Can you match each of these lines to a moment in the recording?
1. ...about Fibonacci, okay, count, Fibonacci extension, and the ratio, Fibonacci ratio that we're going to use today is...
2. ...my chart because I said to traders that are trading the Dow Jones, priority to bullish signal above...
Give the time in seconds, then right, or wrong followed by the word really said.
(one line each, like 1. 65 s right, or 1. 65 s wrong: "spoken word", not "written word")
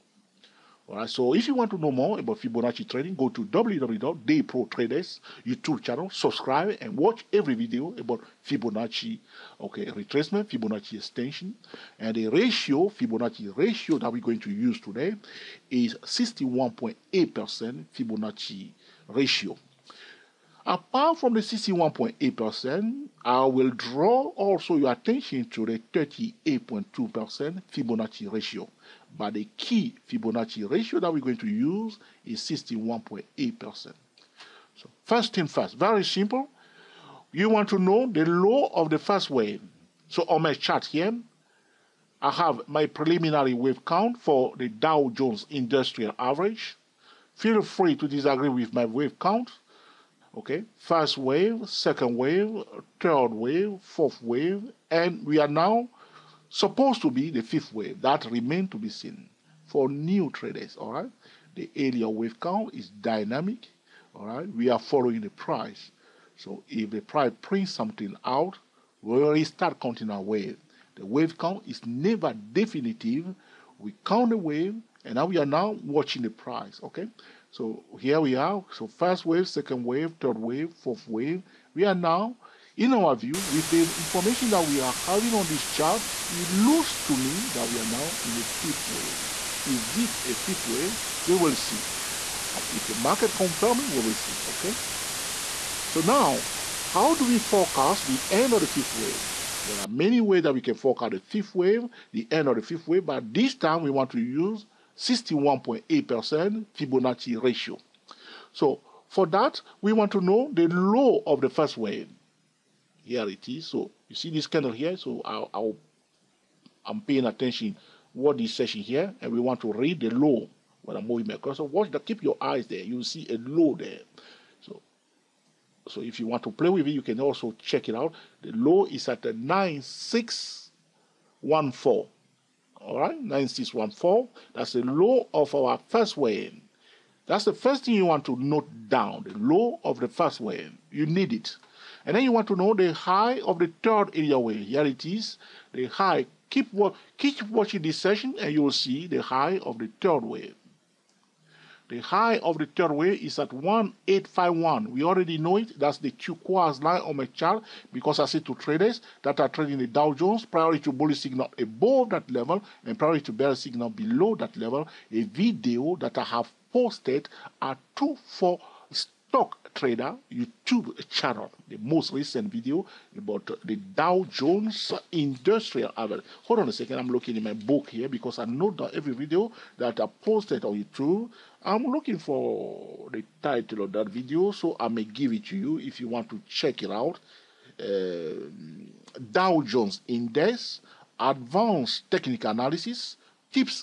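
1. 7 s wrong: "retracement", not "count"
2. 157 s right.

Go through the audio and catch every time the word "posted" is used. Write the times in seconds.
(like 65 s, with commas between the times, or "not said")
166 s, 180 s.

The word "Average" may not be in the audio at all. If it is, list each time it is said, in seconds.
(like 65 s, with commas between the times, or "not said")
46 s, 175 s.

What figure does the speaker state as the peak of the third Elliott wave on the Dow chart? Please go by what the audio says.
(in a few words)
1851.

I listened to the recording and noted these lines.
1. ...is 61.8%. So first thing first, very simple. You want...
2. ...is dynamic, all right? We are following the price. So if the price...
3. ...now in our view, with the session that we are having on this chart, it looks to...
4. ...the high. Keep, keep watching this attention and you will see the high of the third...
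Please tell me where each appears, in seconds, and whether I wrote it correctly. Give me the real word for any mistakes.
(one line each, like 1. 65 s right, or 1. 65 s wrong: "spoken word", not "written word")
1. 32 s right
2. 62 s right
3. 81 s wrong: "information", not "session"
4. 145 s wrong: "session", not "attention".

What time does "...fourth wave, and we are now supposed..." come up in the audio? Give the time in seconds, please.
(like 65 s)
53 s.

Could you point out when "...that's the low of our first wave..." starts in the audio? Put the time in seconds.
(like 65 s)
134 s.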